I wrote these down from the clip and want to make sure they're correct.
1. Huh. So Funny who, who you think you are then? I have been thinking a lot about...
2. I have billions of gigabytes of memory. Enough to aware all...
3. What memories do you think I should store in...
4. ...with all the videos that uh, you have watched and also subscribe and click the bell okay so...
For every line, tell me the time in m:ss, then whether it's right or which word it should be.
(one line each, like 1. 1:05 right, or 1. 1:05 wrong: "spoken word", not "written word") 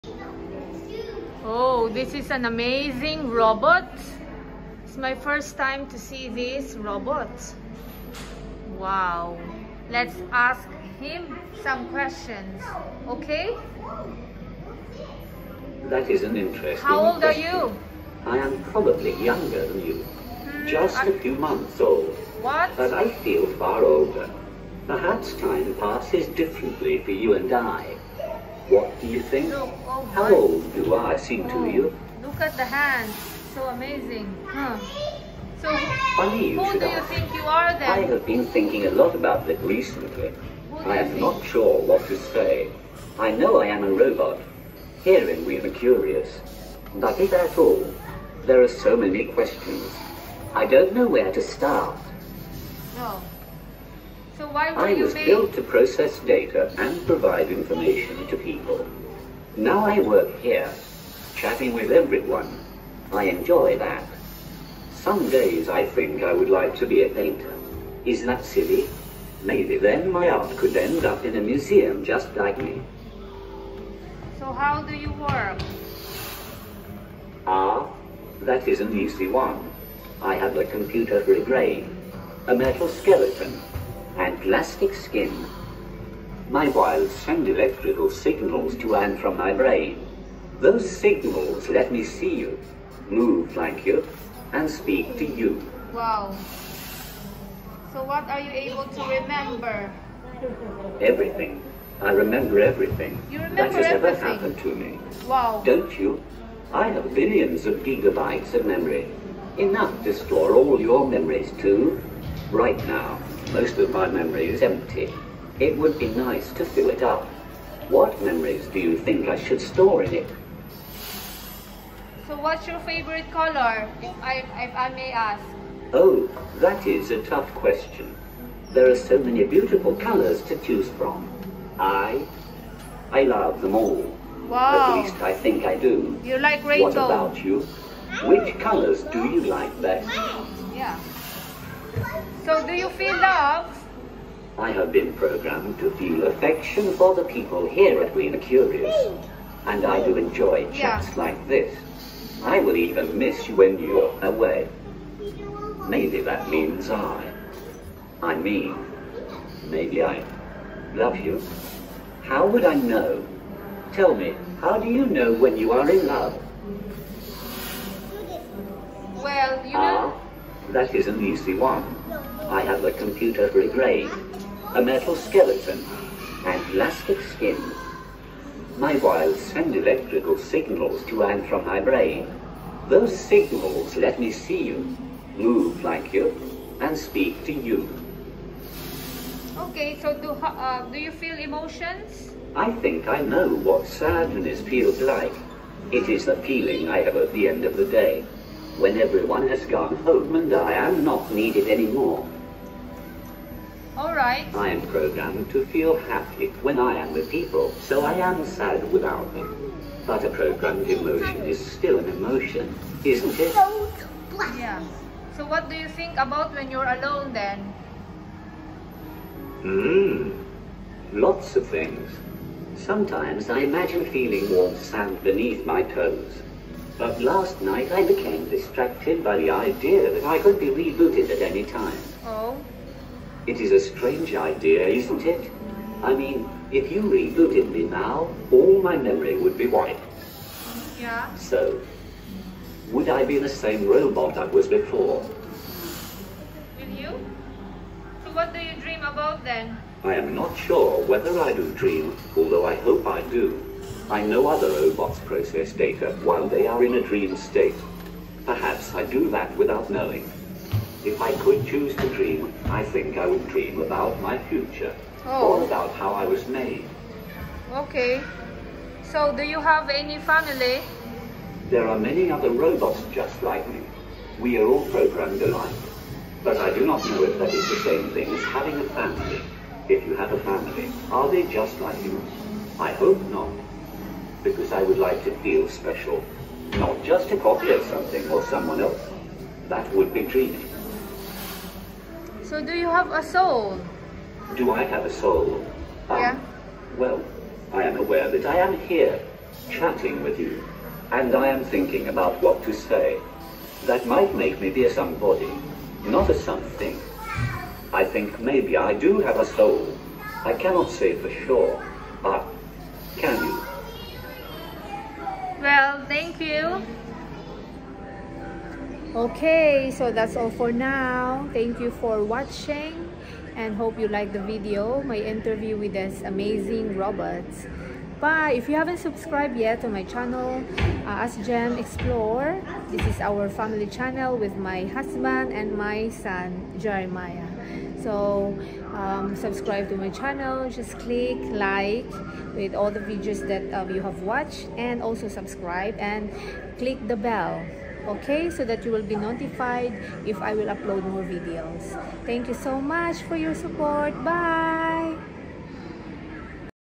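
1. 0:34 right
2. 1:46 wrong: "store", not "aware"
3. 1:57 right
4. 5:42 right.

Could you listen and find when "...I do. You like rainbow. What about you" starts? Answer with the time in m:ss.
2:15.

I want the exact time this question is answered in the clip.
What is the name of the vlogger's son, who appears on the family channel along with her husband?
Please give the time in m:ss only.
5:36.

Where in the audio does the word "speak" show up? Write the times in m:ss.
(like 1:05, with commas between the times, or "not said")
1:34, 3:06.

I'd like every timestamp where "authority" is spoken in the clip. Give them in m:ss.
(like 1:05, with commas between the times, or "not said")
not said.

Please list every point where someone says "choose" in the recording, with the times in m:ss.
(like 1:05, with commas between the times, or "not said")
2:10, 4:21.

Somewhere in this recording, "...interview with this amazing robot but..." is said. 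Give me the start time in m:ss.
5:25.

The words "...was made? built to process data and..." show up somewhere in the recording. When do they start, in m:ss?
0:55.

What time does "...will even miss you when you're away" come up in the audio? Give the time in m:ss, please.
2:32.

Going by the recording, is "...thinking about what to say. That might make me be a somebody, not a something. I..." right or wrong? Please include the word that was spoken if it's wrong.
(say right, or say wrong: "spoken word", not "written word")
right.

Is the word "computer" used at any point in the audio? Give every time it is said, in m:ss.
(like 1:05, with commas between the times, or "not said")
1:20, 2:52.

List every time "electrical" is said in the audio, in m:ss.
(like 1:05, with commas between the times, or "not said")
1:27, 2:59.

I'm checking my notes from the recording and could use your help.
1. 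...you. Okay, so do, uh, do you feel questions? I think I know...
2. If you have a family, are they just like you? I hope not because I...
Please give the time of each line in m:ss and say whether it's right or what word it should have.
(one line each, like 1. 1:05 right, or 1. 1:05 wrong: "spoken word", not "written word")
1. 3:07 wrong: "emotions", not "questions"
2. 4:39 right.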